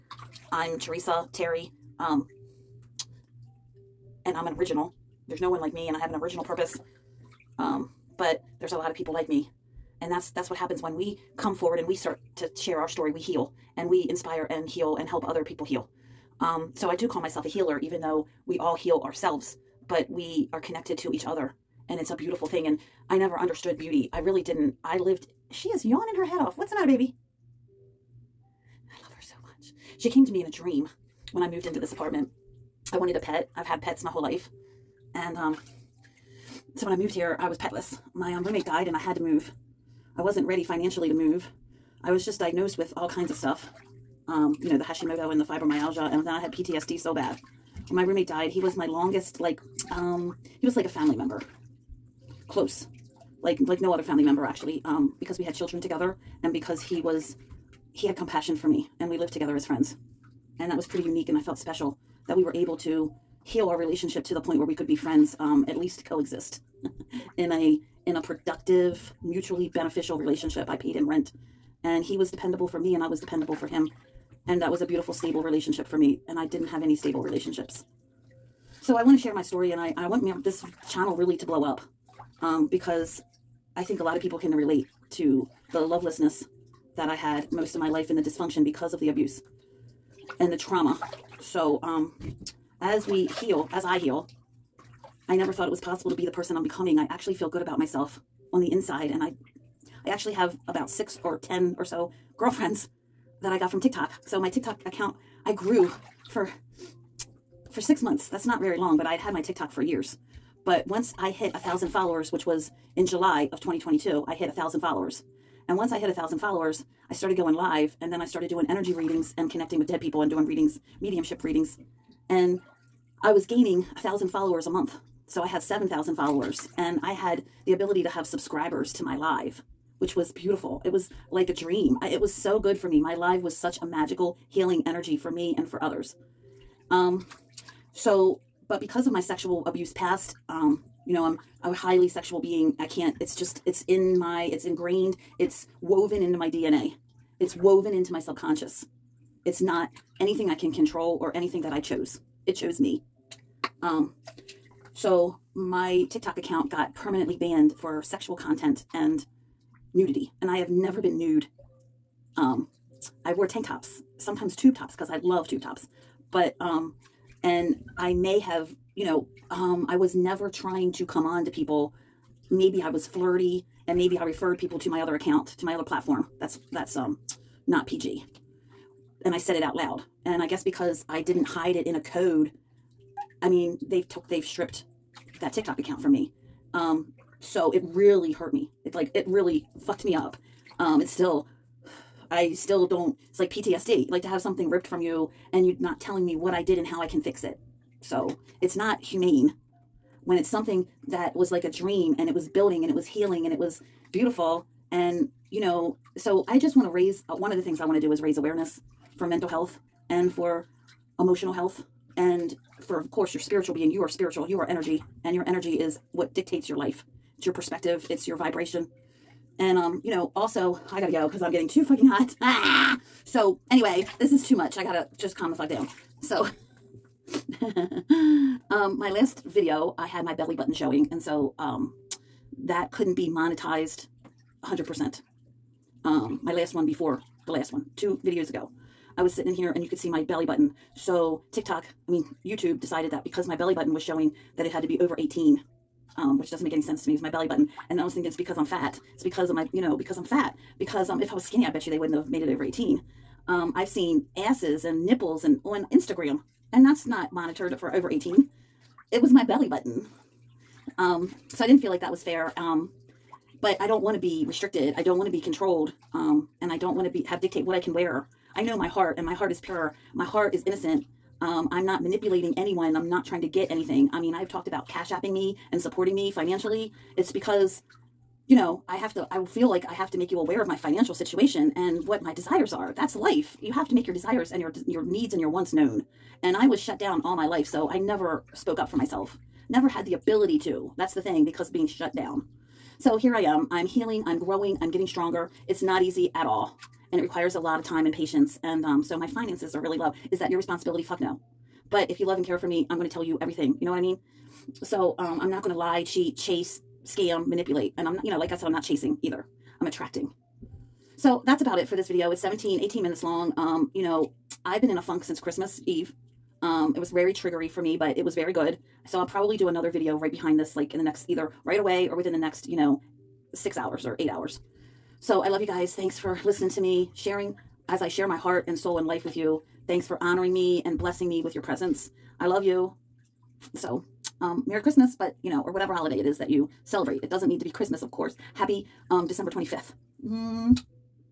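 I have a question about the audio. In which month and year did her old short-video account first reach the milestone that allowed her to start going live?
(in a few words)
July 2022.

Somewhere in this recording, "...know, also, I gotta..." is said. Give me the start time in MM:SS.
03:40.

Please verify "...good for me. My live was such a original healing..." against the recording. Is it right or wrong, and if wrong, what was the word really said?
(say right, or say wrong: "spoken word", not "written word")
wrong: "magical", not "original".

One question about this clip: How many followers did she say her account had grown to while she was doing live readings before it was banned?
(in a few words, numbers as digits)
7,000.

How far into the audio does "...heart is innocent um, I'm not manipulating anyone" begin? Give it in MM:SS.
04:30.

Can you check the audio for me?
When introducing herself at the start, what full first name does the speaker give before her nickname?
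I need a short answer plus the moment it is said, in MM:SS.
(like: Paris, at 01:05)
Teresa, at 00:00.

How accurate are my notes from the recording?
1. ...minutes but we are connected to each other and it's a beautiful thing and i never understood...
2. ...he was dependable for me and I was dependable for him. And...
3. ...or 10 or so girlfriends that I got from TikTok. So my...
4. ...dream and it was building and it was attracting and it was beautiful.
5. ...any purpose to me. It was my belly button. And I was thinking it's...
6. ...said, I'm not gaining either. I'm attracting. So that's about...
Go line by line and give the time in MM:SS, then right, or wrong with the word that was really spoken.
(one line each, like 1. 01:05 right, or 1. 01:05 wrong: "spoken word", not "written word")
1. 00:19 wrong: "ourselves", not "minutes"
2. 01:12 right
3. 01:41 right
4. 03:21 wrong: "healing", not "attracting"
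5. 04:06 wrong: "sense", not "purpose"
6. 05:08 wrong: "chasing", not "gaining".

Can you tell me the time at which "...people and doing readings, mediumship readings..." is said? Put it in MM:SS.
02:00.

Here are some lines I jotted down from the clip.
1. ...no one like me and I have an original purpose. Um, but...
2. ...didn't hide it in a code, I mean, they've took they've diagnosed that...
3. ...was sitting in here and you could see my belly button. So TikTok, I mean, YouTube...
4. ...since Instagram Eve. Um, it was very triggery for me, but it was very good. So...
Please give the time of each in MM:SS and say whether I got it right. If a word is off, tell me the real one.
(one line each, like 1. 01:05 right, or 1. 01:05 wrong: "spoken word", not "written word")
1. 00:05 right
2. 03:01 wrong: "stripped", not "diagnosed"
3. 03:59 right
4. 05:15 wrong: "Christmas", not "Instagram".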